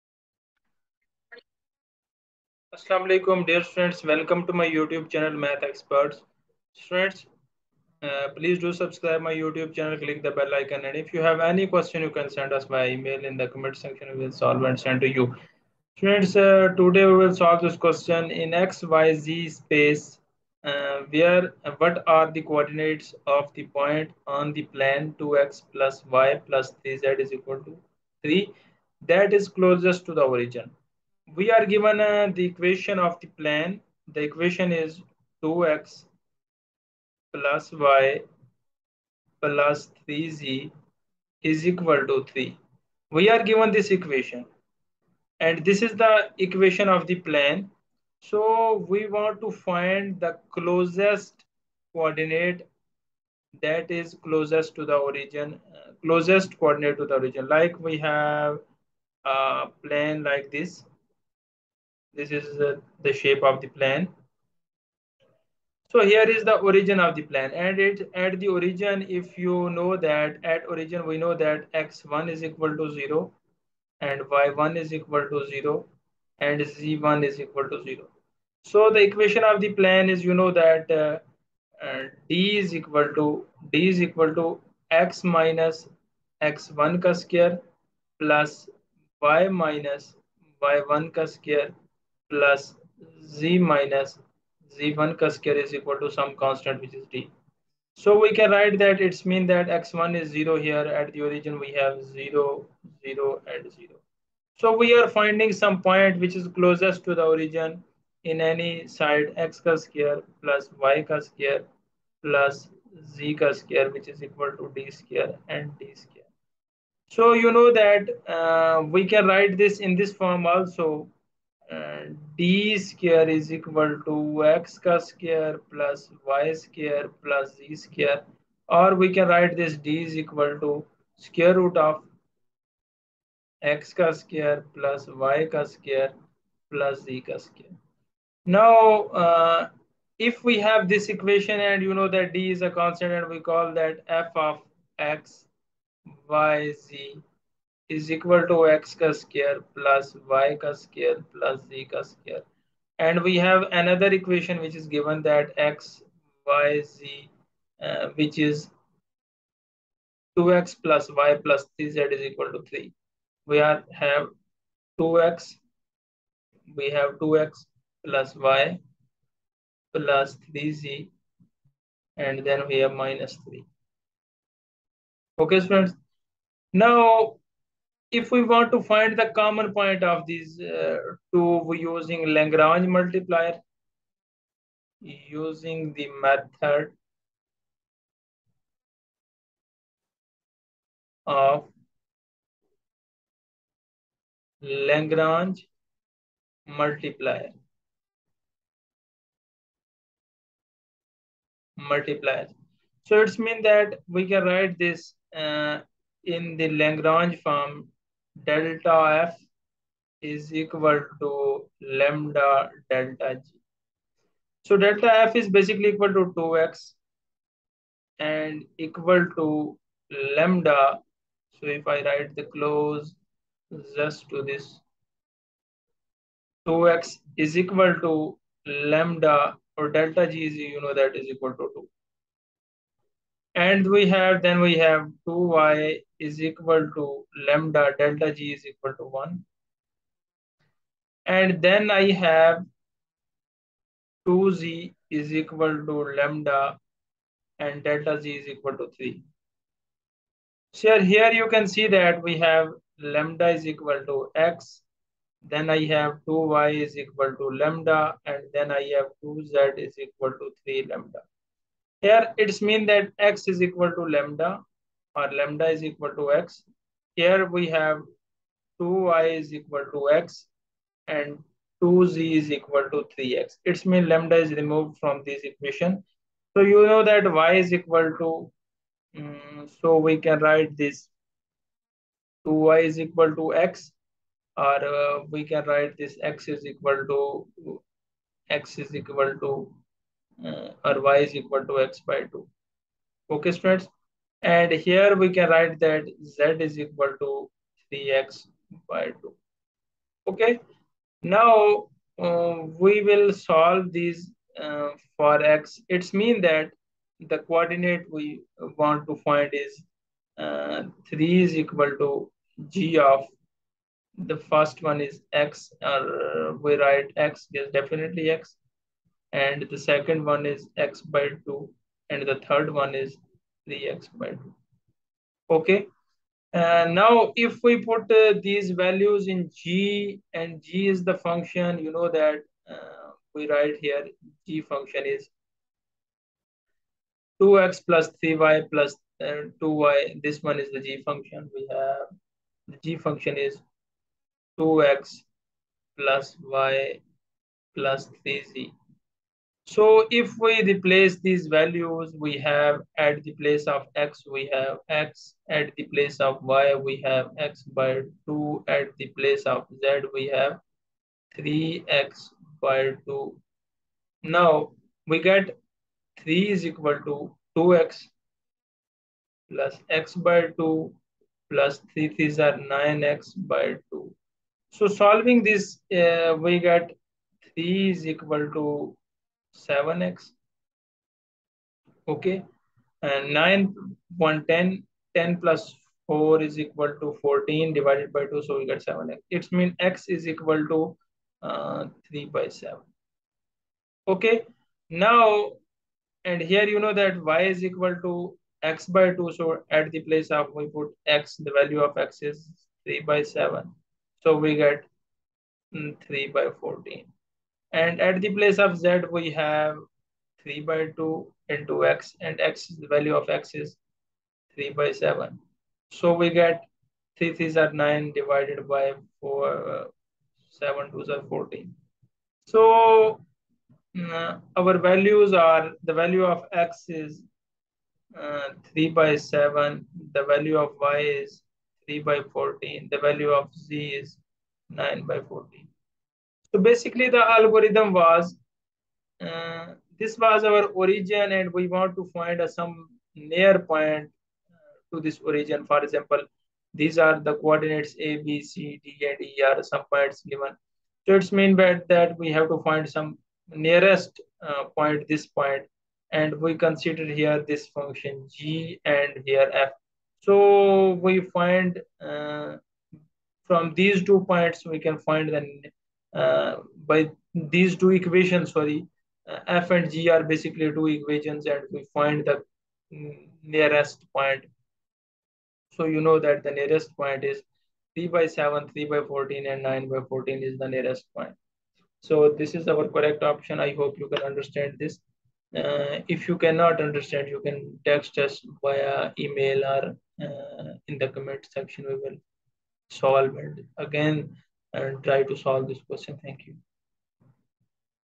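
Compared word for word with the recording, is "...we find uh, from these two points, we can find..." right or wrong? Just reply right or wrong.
right.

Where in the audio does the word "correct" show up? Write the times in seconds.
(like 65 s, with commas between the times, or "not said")
482 s.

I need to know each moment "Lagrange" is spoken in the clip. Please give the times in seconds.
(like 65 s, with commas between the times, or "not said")
182 s, 194 s, 206 s.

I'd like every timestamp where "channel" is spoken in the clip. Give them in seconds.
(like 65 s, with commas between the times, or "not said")
5 s, 9 s.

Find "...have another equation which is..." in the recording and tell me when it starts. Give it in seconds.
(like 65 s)
153 s.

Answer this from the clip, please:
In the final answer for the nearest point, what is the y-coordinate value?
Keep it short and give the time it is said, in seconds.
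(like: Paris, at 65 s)
3/14, at 430 s.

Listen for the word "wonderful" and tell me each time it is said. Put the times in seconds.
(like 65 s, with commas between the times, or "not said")
not said.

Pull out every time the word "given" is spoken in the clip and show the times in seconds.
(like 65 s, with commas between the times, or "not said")
31 s, 43 s, 154 s, 450 s.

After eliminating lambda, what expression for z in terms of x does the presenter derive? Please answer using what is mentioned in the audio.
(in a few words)
3x/2.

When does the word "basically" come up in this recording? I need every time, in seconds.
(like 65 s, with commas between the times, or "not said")
215 s, 436 s, 470 s.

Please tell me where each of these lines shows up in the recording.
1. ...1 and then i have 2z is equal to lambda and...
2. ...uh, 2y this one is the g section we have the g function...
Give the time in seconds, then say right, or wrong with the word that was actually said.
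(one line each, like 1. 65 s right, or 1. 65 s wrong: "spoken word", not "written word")
1. 239 s right
2. 339 s wrong: "function", not "section".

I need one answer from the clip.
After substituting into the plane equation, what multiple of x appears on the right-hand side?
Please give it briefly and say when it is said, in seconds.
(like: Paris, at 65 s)
7x, at 377 s.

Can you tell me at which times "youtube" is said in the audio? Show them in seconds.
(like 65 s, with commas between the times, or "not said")
4 s, 9 s.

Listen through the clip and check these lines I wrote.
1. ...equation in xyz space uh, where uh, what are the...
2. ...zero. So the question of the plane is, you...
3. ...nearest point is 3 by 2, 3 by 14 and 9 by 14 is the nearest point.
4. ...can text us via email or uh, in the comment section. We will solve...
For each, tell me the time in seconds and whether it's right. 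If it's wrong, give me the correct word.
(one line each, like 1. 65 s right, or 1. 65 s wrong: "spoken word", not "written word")
1. 17 s wrong: "question", not "equation"
2. 77 s wrong: "equation", not "question"
3. 476 s wrong: "7", not "2"
4. 487 s right.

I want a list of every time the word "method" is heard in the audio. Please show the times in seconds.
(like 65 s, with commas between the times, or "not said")
186 s.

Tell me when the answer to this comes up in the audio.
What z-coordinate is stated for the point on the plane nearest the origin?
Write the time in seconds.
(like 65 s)
432 s.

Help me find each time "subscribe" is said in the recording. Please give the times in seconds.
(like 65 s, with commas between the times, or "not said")
8 s.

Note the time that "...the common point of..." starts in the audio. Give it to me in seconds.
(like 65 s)
179 s.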